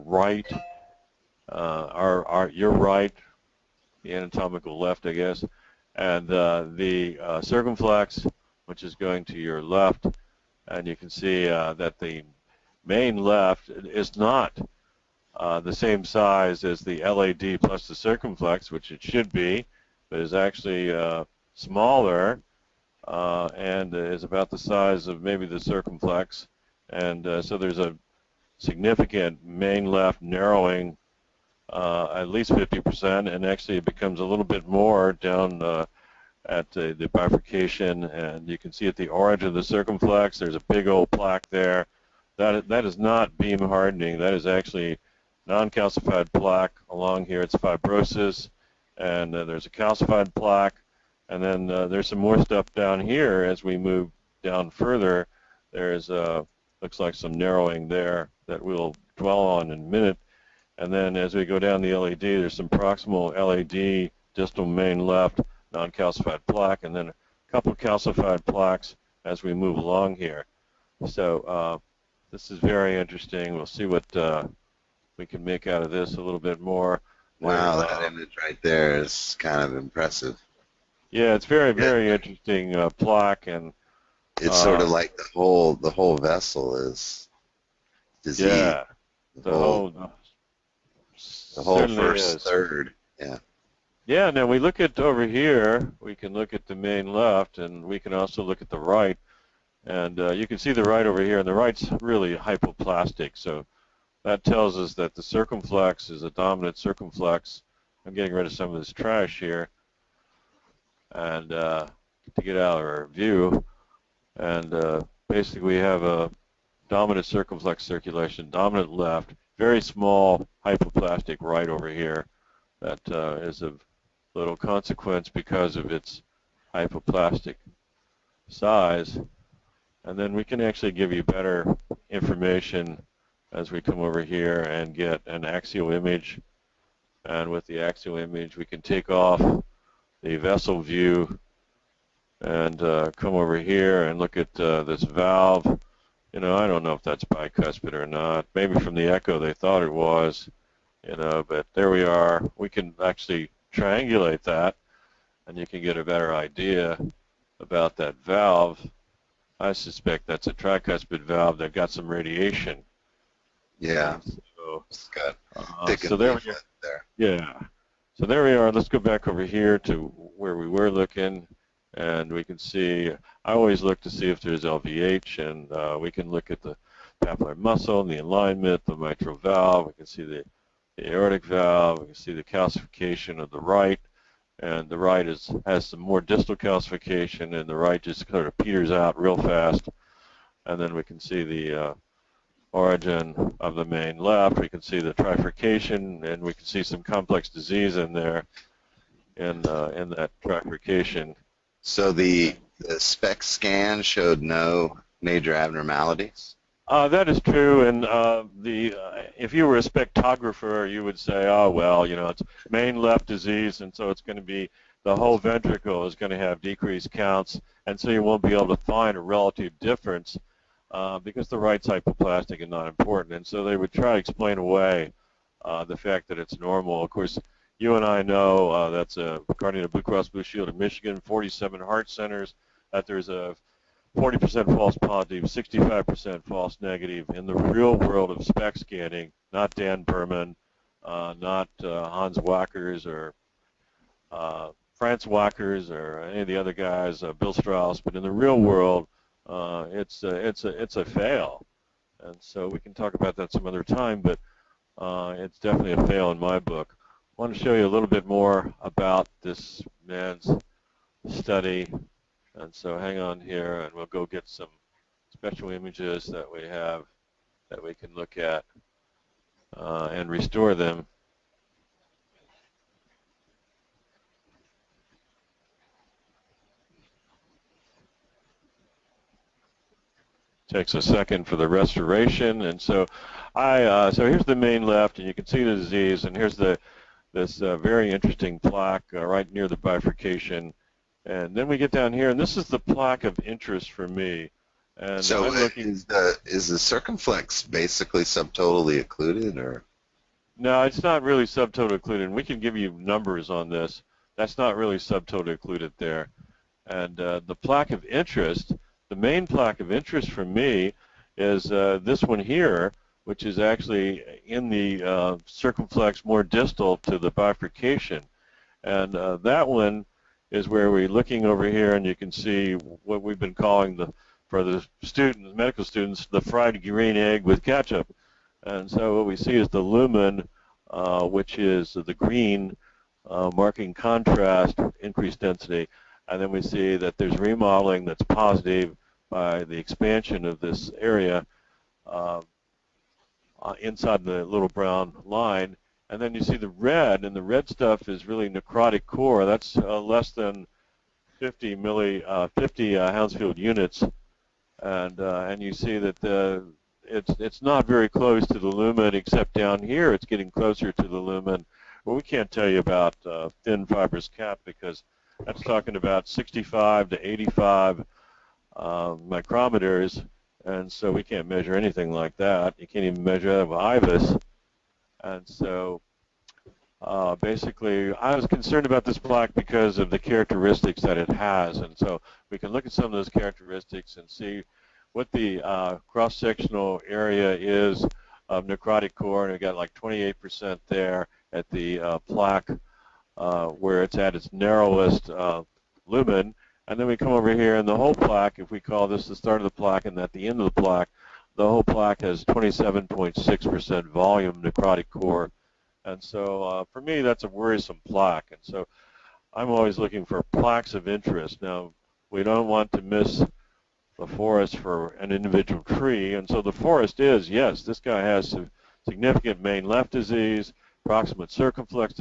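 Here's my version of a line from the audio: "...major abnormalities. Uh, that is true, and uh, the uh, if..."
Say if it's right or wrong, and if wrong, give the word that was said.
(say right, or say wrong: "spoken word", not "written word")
right.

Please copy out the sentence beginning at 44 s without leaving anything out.
That is actually non-calcified plaque along here.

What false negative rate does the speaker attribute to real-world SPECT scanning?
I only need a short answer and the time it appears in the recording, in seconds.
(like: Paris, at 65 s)
65%, at 235 s.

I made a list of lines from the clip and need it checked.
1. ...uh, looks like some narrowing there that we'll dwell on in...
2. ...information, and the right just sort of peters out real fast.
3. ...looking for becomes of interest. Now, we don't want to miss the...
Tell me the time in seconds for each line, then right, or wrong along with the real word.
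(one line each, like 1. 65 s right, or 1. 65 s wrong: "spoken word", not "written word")
1. 56 s right
2. 186 s wrong: "calcification", not "information"
3. 409 s wrong: "plaques", not "becomes".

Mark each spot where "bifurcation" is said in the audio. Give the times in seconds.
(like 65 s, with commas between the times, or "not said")
37 s, 289 s, 317 s.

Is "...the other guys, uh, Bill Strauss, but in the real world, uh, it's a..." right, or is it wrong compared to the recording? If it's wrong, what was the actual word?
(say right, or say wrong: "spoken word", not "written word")
right.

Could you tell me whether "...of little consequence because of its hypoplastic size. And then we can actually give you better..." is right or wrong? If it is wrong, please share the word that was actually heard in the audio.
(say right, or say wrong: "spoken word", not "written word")
right.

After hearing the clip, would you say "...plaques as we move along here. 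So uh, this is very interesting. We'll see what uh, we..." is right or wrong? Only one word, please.
right.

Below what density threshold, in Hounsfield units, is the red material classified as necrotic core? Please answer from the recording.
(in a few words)
50.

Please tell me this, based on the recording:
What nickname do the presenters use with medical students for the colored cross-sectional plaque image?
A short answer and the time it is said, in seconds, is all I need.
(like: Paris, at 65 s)
fried green egg with ketchup, at 326 s.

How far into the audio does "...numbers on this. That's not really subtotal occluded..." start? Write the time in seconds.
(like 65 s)
302 s.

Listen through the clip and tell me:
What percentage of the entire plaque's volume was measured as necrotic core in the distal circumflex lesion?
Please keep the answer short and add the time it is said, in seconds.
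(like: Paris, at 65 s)
27.6%, at 402 s.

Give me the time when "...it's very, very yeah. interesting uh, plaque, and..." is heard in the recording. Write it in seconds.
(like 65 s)
81 s.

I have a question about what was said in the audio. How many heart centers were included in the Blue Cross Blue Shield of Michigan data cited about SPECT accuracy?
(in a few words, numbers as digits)
47.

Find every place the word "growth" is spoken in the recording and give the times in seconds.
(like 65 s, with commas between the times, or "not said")
not said.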